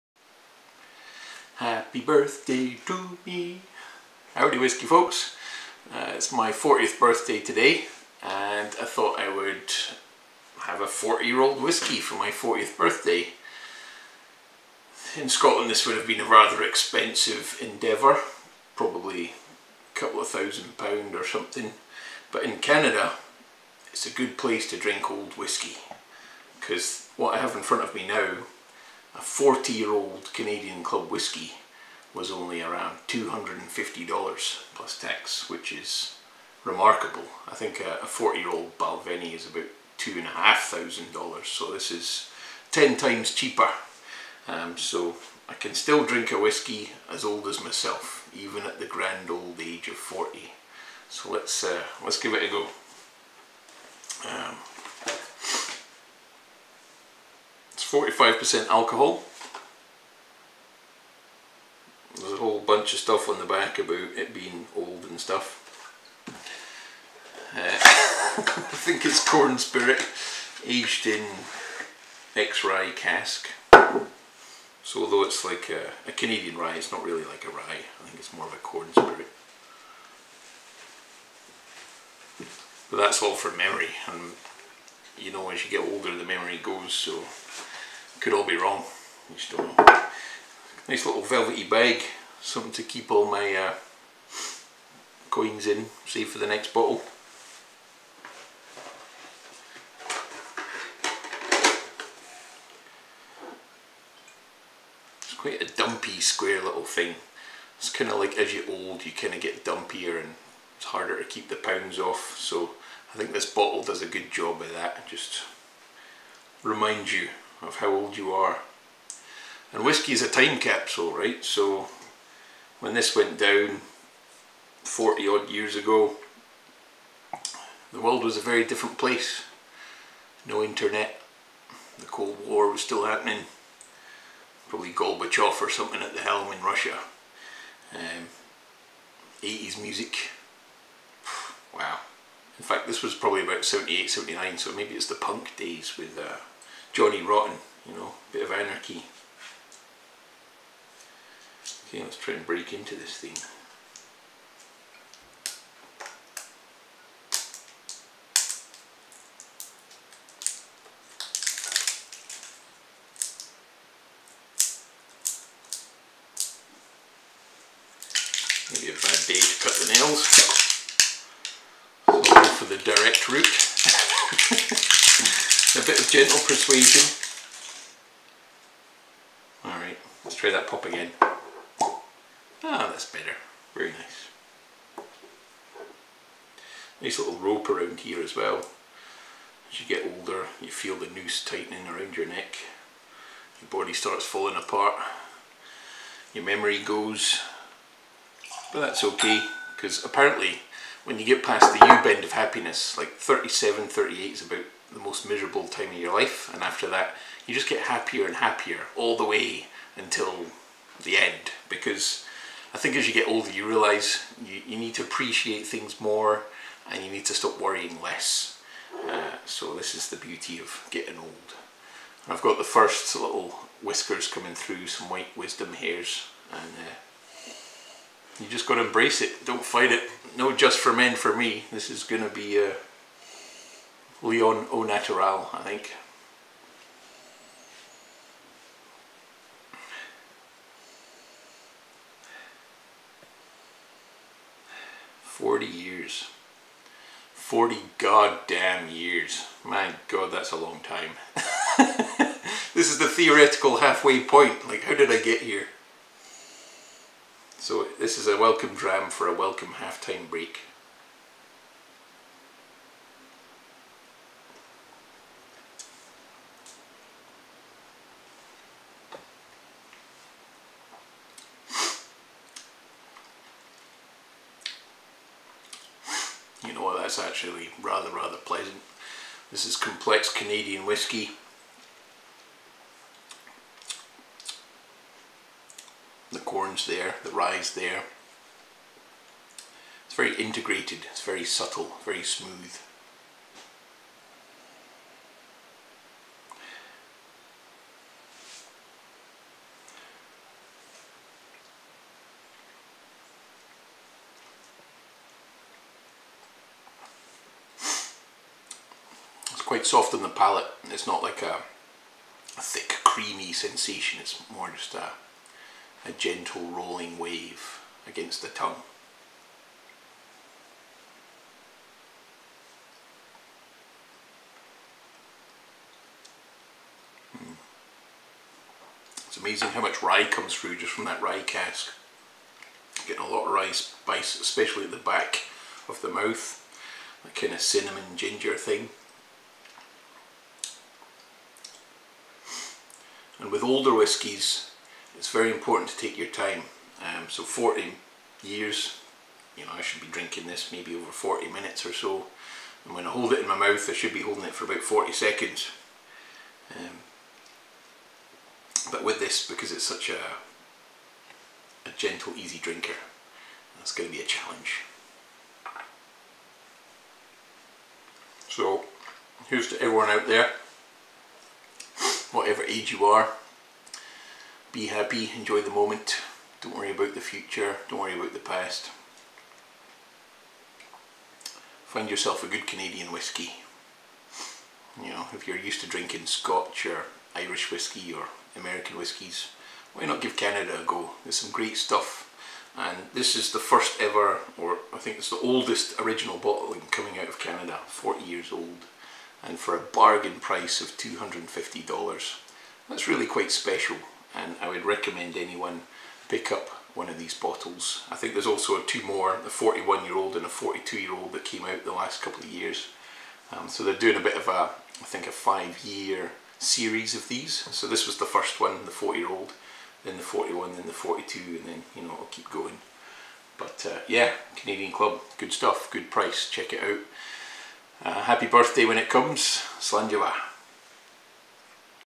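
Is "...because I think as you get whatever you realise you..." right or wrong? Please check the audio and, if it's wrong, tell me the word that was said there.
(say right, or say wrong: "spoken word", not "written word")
wrong: "older", not "whatever".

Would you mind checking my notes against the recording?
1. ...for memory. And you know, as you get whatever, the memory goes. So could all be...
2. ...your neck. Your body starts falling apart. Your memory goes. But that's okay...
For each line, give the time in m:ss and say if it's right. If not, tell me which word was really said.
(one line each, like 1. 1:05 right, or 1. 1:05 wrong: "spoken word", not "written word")
1. 1:23 wrong: "older", not "whatever"
2. 3:12 right.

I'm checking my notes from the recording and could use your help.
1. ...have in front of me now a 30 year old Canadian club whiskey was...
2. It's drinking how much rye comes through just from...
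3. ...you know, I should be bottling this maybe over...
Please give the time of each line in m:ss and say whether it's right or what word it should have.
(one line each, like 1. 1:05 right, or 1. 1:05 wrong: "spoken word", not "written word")
1. 0:27 wrong: "40", not "30"
2. 5:29 wrong: "amazing", not "drinking"
3. 5:49 wrong: "drinking", not "bottling".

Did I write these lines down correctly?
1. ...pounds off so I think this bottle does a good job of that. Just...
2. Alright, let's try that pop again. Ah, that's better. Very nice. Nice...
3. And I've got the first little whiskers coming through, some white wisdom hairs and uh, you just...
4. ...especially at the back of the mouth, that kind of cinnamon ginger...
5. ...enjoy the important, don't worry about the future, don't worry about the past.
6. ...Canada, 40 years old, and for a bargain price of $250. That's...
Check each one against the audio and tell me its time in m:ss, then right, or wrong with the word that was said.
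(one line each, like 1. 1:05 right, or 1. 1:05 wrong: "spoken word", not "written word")
1. 1:51 right
2. 2:59 right
3. 3:42 right
4. 5:34 right
5. 6:15 wrong: "moment", not "important"
6. 6:37 right.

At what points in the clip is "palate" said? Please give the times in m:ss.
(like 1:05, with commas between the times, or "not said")
5:10.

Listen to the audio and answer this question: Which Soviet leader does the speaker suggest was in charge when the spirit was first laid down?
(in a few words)
Gorbachev.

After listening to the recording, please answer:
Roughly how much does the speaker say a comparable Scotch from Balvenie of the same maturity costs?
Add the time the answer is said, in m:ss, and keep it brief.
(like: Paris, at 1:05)
$2,500, at 0:39.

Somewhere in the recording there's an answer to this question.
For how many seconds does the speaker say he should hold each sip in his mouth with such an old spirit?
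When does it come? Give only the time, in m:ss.
5:54.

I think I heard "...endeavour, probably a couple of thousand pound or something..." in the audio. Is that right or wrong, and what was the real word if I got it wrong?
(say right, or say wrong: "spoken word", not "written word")
right.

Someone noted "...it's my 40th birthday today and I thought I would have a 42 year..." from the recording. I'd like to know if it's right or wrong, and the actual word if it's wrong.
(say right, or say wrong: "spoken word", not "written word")
wrong: "40", not "42".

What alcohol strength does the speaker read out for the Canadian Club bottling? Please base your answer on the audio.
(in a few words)
45%.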